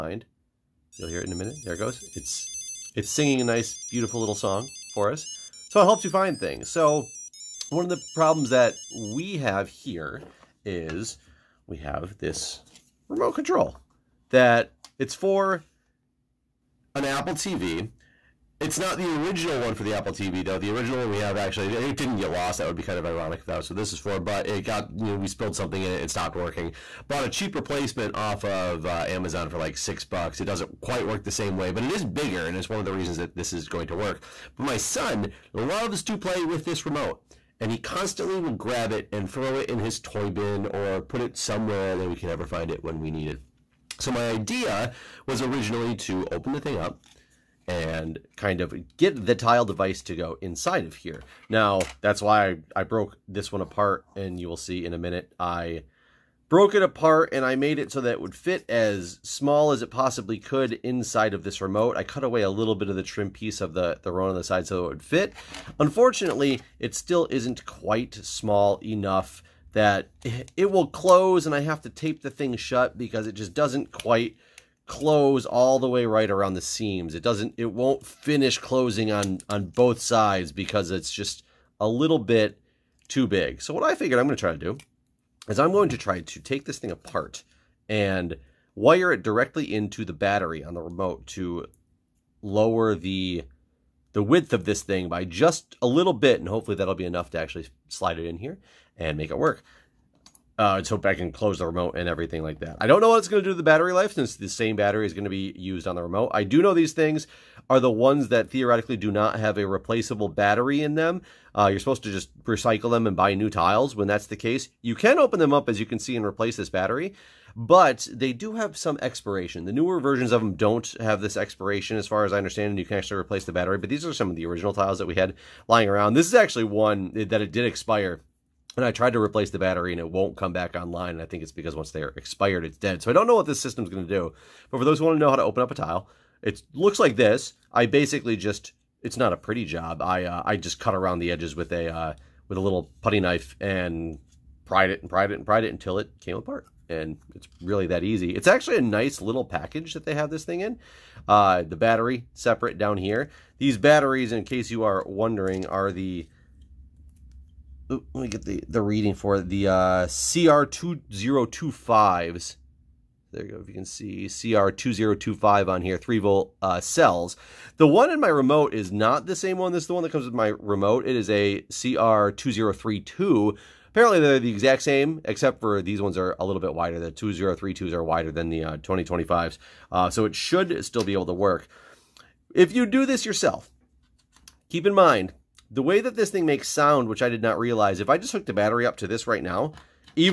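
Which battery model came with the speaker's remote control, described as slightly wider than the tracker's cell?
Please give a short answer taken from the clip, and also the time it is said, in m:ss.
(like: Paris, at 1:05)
CR2032, at 2:51.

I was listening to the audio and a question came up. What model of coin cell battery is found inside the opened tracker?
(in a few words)
CR2025.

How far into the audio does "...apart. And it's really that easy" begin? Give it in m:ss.
2:26.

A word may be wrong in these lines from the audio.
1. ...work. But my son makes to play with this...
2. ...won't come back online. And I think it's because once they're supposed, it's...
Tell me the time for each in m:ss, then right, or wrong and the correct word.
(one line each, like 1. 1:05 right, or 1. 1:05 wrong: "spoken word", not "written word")
1. 0:33 wrong: "loves", not "makes"
2. 2:10 wrong: "expired", not "supposed".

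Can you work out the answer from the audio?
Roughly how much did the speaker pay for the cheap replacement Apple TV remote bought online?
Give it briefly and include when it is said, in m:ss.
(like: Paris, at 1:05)
$6, at 0:29.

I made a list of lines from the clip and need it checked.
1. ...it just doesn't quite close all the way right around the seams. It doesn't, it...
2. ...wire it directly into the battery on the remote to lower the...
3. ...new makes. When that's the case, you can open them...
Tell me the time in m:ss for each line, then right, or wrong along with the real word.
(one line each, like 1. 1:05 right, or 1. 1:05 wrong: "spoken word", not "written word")
1. 1:13 right
2. 1:28 right
3. 1:53 wrong: "tiles", not "makes".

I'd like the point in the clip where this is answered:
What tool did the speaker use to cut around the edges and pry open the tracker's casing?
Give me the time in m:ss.
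2:23.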